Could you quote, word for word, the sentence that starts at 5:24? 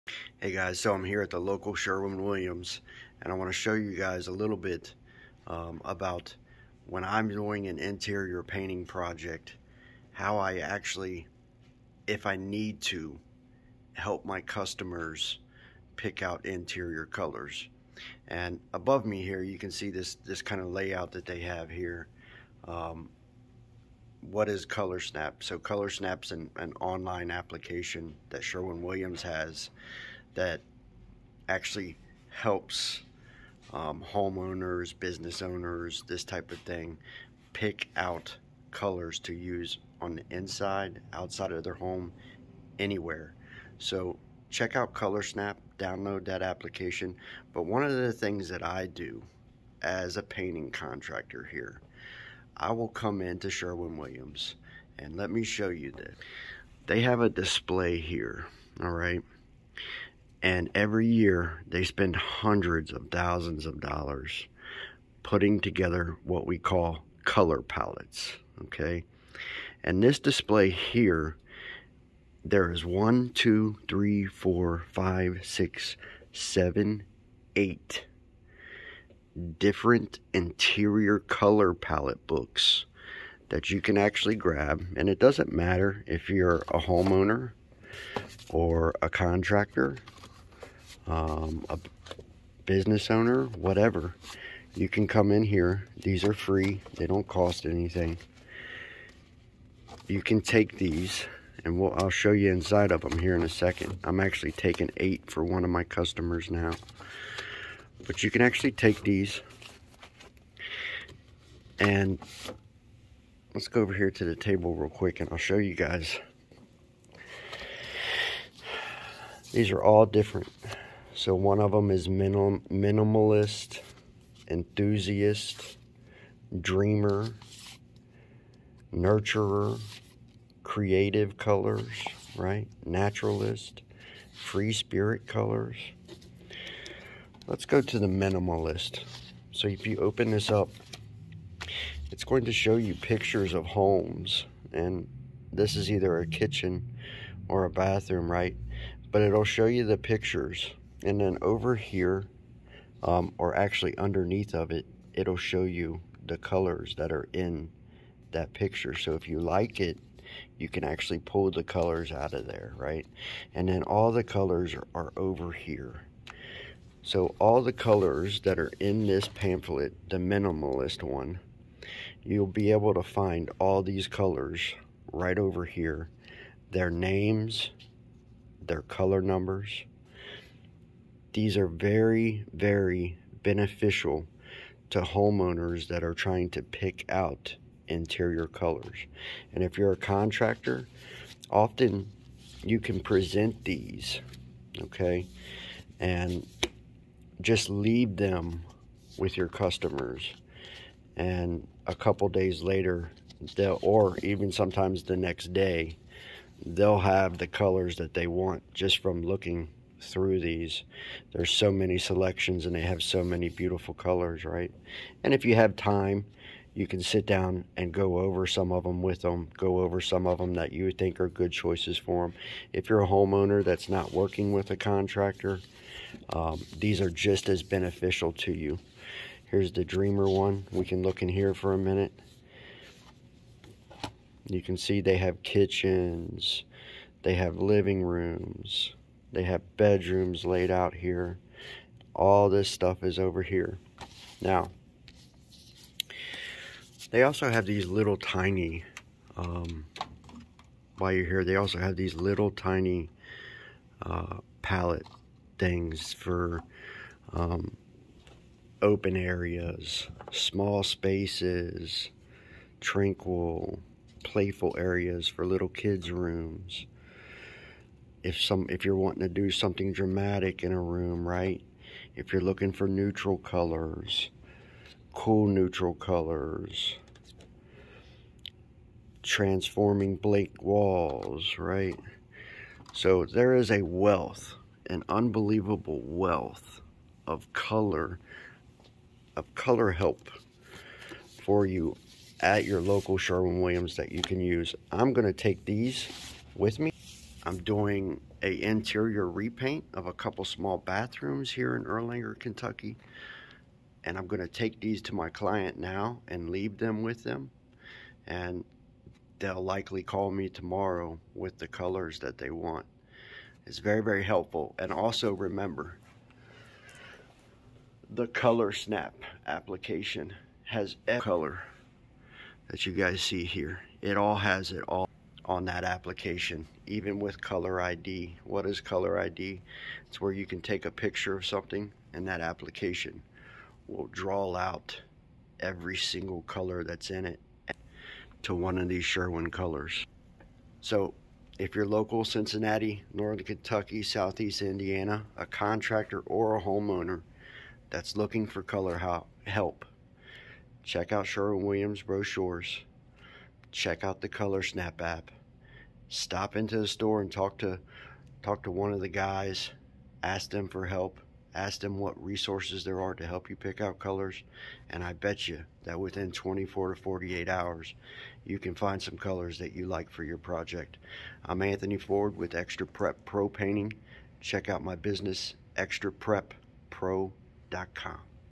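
It all has it all on that application, even with Color ID.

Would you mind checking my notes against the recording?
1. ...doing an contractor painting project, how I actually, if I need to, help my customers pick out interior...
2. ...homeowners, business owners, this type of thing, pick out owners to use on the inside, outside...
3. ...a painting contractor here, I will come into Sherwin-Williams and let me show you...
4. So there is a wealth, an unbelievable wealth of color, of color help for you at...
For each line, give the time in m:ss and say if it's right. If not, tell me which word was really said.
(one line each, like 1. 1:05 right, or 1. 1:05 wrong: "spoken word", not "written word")
1. 0:07 wrong: "interior", not "contractor"
2. 0:34 wrong: "colors", not "owners"
3. 0:50 right
4. 4:42 right.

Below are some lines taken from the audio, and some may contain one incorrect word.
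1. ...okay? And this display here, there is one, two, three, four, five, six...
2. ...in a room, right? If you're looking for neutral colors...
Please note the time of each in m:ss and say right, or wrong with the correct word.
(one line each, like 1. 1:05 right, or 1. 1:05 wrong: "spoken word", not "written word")
1. 1:08 right
2. 4:30 right.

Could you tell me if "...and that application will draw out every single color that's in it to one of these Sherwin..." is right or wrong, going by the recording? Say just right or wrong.
right.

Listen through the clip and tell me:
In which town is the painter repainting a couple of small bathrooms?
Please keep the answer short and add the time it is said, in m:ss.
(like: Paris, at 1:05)
Erlanger, Kentucky, at 5:01.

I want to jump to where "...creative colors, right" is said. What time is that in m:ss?
2:10.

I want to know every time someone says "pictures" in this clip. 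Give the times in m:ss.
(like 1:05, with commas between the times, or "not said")
2:22, 2:29, 2:38, 5:30.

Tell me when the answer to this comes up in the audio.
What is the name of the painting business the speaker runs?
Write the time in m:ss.
6:12.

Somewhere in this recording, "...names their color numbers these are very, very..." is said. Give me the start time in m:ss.
2:56.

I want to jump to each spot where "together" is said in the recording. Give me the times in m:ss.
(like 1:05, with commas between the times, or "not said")
1:05.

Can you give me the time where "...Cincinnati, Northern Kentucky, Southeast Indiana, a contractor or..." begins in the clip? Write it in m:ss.
5:42.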